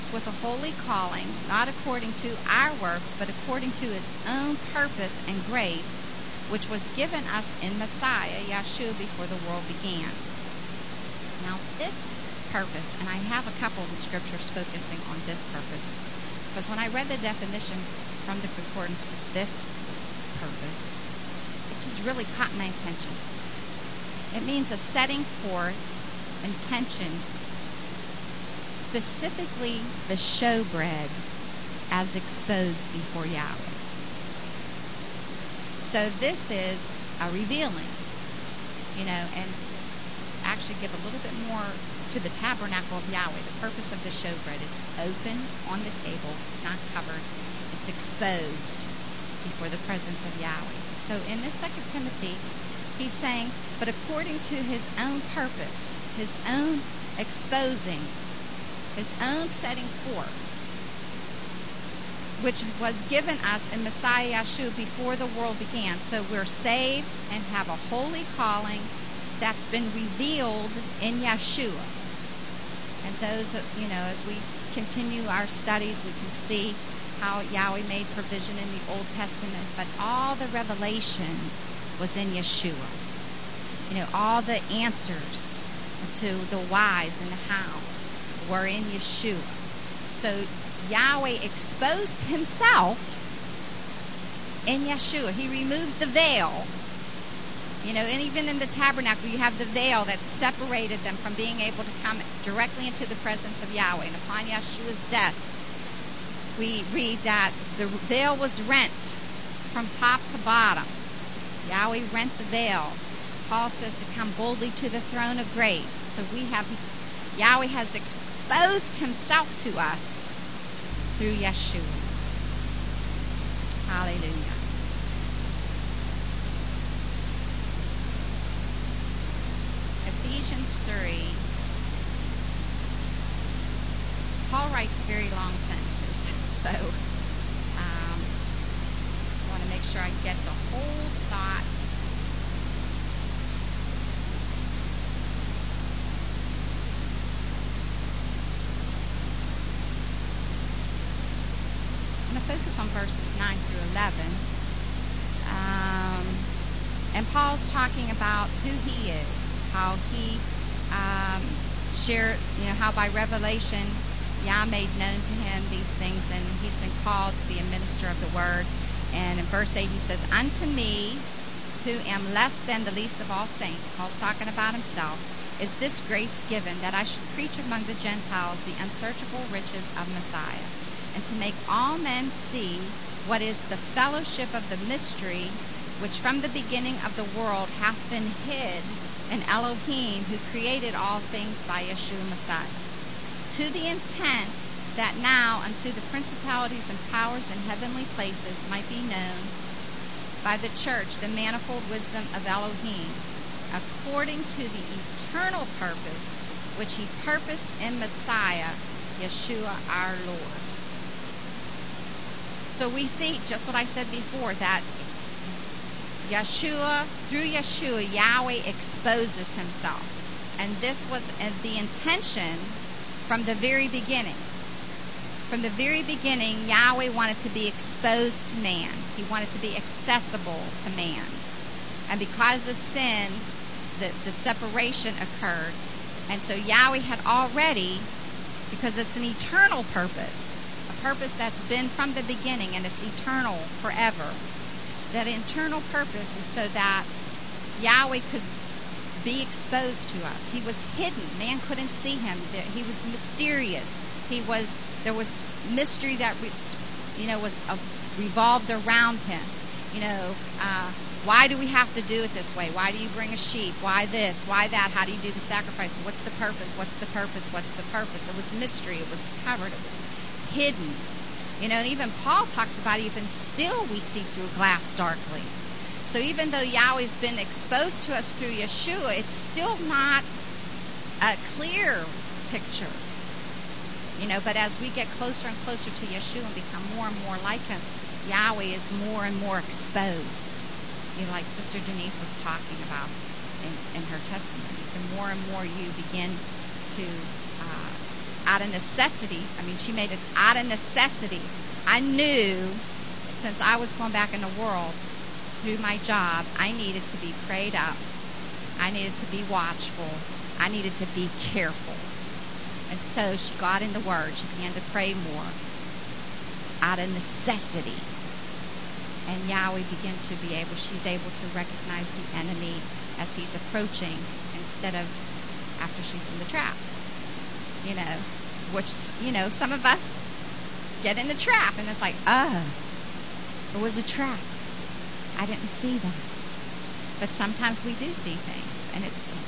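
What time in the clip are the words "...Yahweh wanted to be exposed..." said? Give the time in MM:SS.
03:46.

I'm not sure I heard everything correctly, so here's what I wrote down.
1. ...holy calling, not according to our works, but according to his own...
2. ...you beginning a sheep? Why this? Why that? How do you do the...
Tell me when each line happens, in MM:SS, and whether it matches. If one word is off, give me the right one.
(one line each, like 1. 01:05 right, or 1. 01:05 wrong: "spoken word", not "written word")
1. 00:00 right
2. 04:22 wrong: "bring", not "beginning".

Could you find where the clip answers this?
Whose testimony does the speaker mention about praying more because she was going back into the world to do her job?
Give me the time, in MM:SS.
04:51.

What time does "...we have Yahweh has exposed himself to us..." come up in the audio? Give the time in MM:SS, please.
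01:56.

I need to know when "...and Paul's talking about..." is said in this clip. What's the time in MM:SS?
02:37.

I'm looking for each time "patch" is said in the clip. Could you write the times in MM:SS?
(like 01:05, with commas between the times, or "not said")
not said.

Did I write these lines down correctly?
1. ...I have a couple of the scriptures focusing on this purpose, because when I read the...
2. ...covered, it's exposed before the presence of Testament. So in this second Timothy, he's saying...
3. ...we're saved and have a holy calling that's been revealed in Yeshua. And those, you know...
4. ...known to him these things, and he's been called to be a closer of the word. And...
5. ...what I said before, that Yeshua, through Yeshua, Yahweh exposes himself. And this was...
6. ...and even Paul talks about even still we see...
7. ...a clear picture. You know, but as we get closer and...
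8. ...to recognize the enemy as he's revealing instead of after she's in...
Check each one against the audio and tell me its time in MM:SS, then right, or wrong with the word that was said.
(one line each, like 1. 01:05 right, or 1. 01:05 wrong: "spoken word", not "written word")
1. 00:13 right
2. 00:46 wrong: "Yahweh", not "Testament"
3. 01:06 right
4. 02:44 wrong: "minister", not "closer"
5. 03:33 right
6. 04:31 right
7. 04:41 right
8. 05:21 wrong: "approaching", not "revealing".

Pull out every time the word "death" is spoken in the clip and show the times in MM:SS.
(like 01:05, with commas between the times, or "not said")
01:45.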